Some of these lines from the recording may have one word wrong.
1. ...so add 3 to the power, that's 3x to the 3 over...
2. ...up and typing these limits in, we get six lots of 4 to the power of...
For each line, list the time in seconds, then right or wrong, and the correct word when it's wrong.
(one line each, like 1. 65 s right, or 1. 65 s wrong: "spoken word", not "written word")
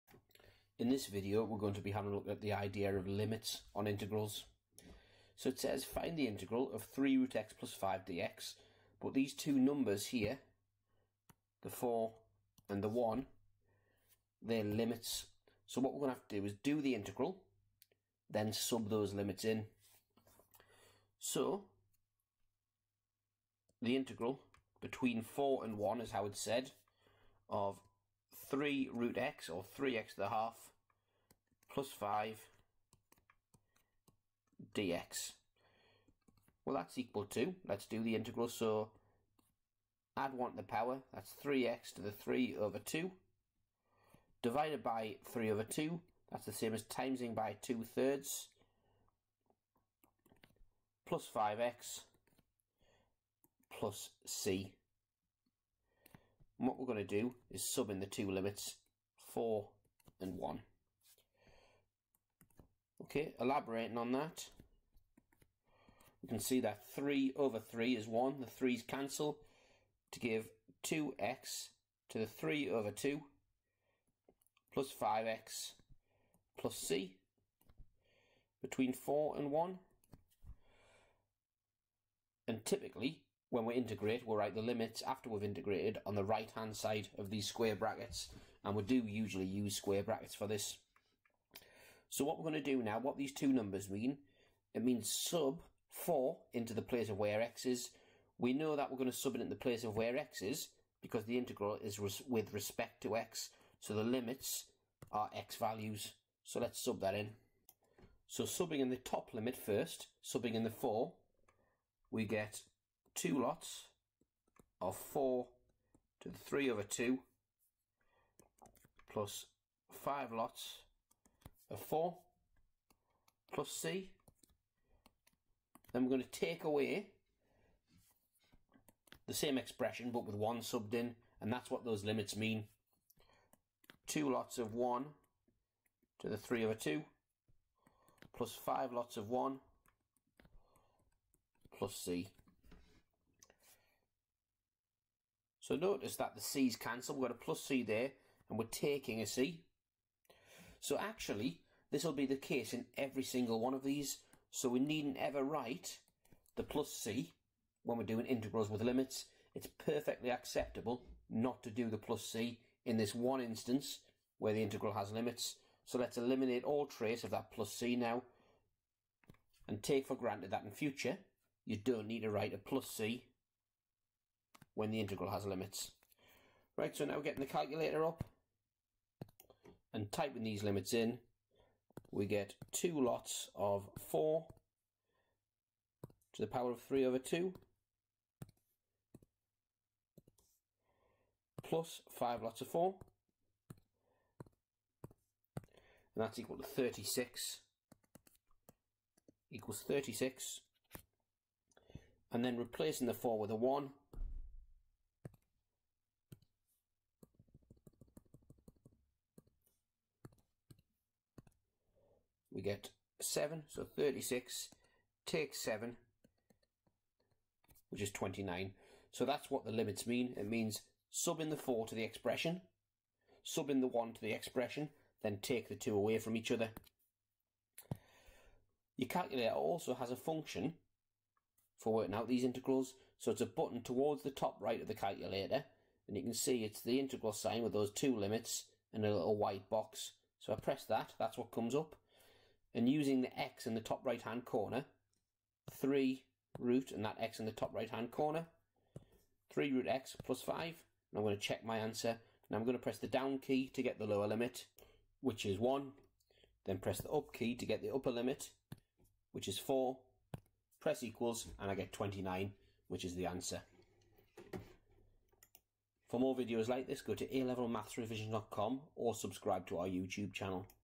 1. 38 s wrong: "1", not "3"
2. 178 s wrong: "two", not "six".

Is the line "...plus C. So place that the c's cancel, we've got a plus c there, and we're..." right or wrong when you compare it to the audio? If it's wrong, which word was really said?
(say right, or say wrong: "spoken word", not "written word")
wrong: "notice", not "place".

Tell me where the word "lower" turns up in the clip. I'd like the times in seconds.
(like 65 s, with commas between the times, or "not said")
254 s.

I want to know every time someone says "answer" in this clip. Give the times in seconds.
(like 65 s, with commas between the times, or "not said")
251 s, 263 s.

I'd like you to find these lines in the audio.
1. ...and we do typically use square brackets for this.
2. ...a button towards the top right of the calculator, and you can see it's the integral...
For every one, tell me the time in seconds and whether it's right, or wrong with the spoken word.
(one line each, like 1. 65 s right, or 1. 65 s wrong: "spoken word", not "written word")
1. 88 s wrong: "usually", not "typically"
2. 233 s right.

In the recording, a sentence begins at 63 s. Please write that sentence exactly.
Okay, elaborating on that, we can see that 3 over 3 is 1.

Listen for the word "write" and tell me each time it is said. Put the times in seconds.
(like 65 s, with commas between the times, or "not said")
84 s, 155 s, 172 s.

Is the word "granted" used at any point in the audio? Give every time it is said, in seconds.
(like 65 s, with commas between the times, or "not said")
170 s.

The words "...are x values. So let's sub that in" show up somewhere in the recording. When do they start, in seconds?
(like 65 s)
105 s.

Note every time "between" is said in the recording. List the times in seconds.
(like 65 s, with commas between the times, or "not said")
24 s, 78 s.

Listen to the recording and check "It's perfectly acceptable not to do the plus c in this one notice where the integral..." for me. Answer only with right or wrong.
wrong.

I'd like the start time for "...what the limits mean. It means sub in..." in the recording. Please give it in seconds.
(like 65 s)
219 s.